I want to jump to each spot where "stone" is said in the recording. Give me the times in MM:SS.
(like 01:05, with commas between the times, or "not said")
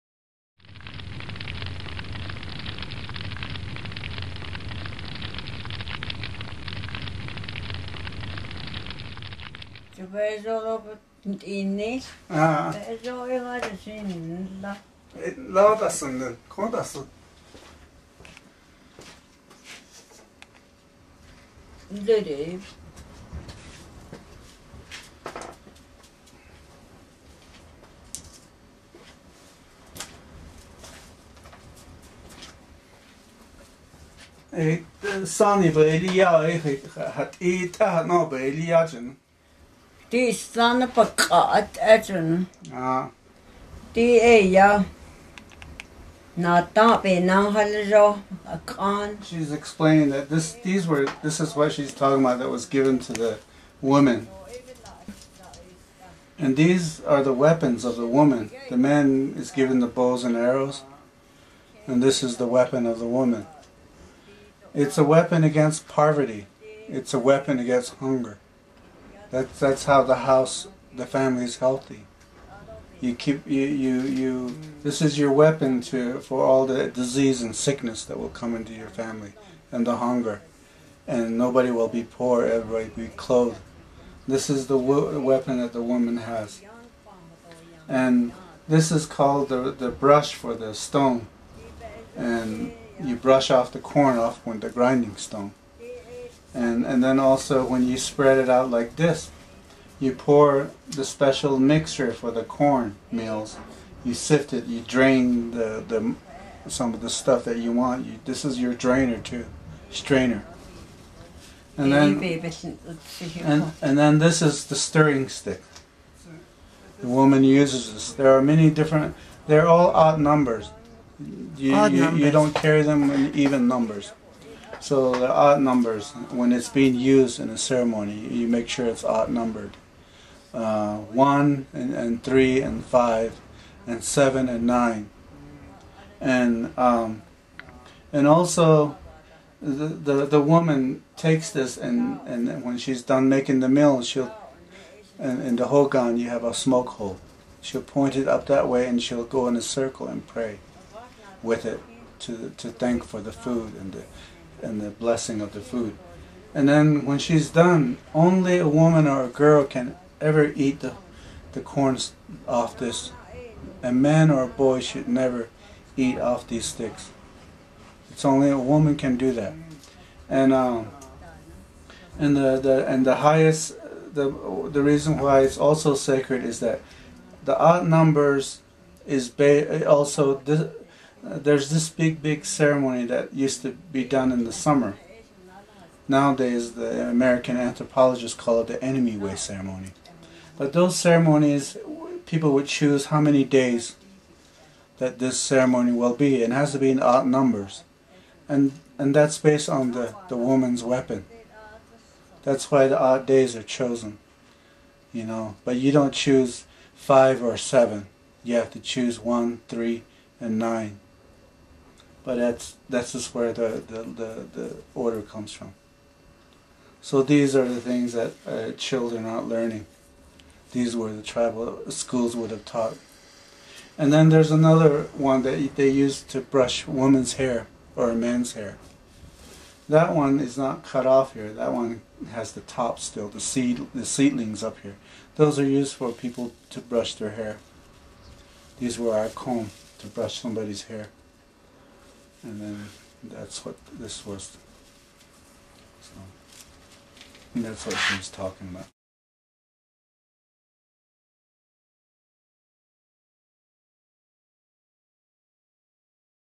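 01:30, 01:35.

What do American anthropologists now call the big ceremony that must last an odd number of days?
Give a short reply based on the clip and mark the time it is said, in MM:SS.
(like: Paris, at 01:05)
Enemy Way ceremony, at 03:08.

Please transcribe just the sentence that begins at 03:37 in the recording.
So these are the things that uh, children aren't learning.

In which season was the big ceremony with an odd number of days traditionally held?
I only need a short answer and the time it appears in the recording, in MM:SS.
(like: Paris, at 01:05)
summer, at 03:04.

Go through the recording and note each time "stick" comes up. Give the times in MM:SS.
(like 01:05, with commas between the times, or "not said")
01:55, 02:46.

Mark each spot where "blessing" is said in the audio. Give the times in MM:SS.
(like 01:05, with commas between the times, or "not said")
02:34.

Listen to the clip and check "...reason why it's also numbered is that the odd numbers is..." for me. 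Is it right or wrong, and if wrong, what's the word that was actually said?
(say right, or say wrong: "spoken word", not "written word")
wrong: "sacred", not "numbered".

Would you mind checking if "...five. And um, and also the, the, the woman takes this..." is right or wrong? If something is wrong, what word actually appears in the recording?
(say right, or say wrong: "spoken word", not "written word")
wrong: "nine", not "five".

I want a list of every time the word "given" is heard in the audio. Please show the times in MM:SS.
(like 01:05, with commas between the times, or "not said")
00:52, 00:59.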